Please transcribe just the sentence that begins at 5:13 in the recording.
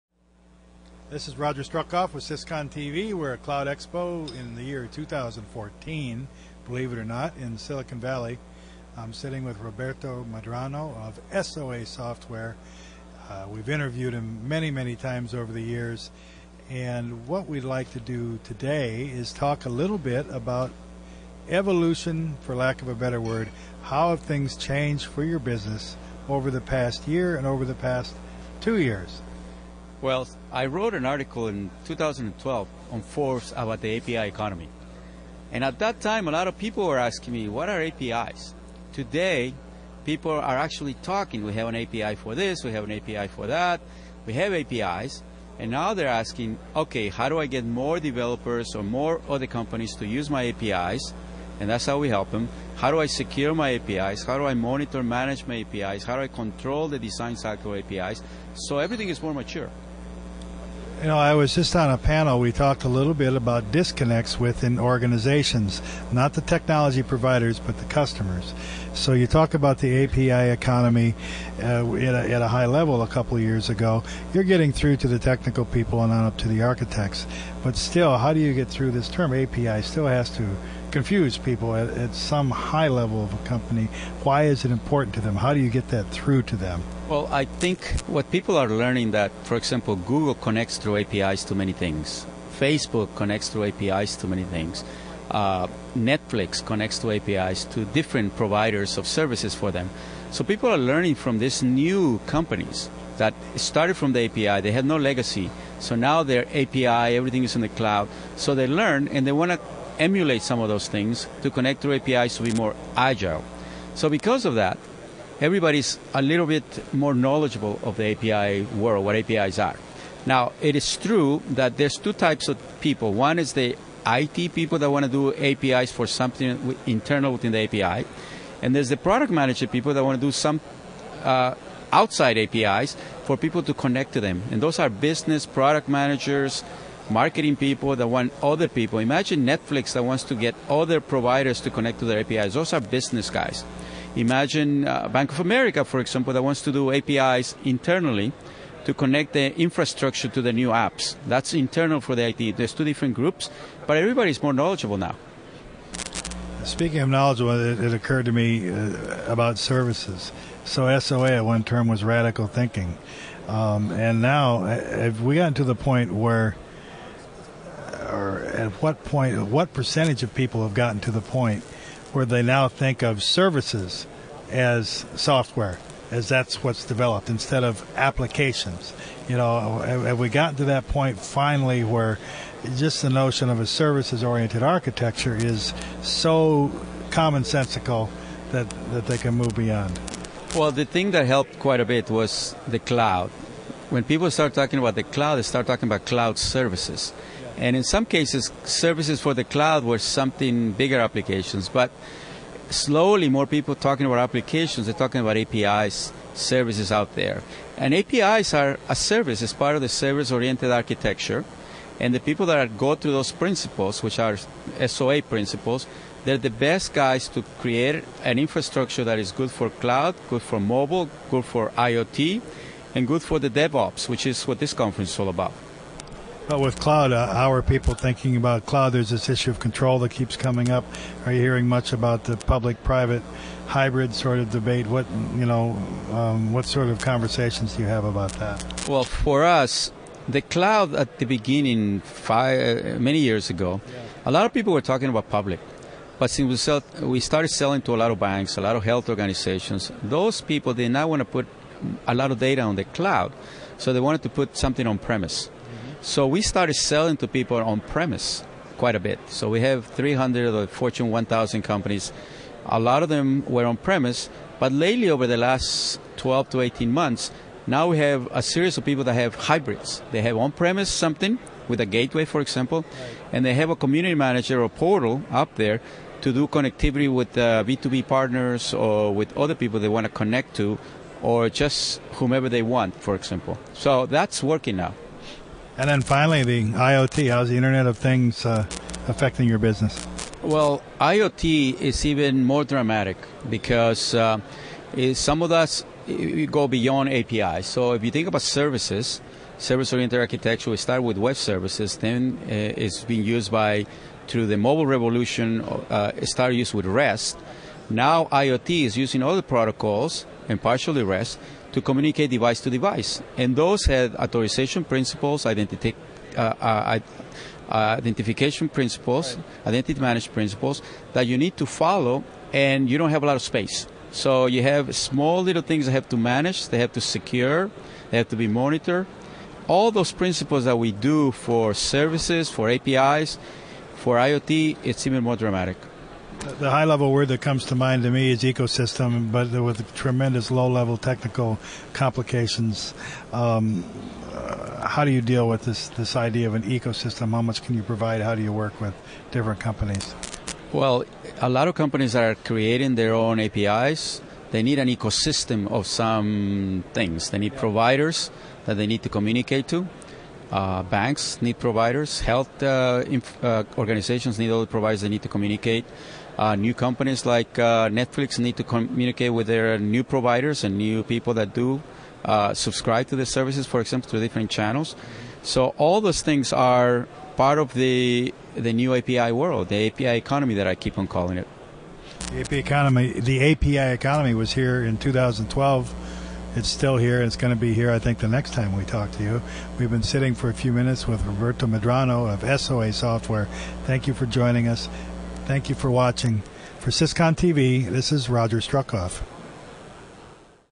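And those had authorization principles, identity, uh, uh, uh, identification principles, right.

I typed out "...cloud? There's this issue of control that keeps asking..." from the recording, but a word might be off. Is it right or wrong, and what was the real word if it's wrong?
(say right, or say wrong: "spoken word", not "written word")
wrong: "coming", not "asking".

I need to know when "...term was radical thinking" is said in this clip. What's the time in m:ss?
2:41.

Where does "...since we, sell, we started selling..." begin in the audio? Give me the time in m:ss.
4:06.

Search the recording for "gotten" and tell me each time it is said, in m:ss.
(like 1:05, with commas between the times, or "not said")
2:45, 2:50, 3:00.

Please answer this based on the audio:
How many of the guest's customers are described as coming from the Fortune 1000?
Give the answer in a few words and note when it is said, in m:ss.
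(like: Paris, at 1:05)
300, at 4:19.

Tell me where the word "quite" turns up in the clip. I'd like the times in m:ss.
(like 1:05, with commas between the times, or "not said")
3:11, 4:18.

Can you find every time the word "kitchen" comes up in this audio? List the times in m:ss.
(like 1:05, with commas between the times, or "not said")
not said.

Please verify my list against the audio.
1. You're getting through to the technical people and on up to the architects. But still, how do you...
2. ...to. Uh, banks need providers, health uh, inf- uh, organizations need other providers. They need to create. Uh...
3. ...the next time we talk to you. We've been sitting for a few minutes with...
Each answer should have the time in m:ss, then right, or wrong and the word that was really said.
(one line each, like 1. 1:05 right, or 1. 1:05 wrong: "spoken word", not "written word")
1. 1:14 right
2. 5:59 wrong: "communicate", not "create"
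3. 6:28 right.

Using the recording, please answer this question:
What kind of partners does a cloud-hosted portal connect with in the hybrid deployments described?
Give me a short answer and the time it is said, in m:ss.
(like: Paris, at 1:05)
B2B partners, at 4:37.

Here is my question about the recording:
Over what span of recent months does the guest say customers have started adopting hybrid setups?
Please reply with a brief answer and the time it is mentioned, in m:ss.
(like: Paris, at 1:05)
12 to 18 months, at 4:26.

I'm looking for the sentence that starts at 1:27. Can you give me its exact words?
Well, I think what people are learning that, for example, Google connects through APIs to many things.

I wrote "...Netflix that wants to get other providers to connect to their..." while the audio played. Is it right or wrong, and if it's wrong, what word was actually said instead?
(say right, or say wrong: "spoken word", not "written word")
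right.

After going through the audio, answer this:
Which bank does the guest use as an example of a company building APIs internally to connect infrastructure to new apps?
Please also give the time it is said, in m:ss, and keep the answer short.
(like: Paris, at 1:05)
Bank of America, at 2:25.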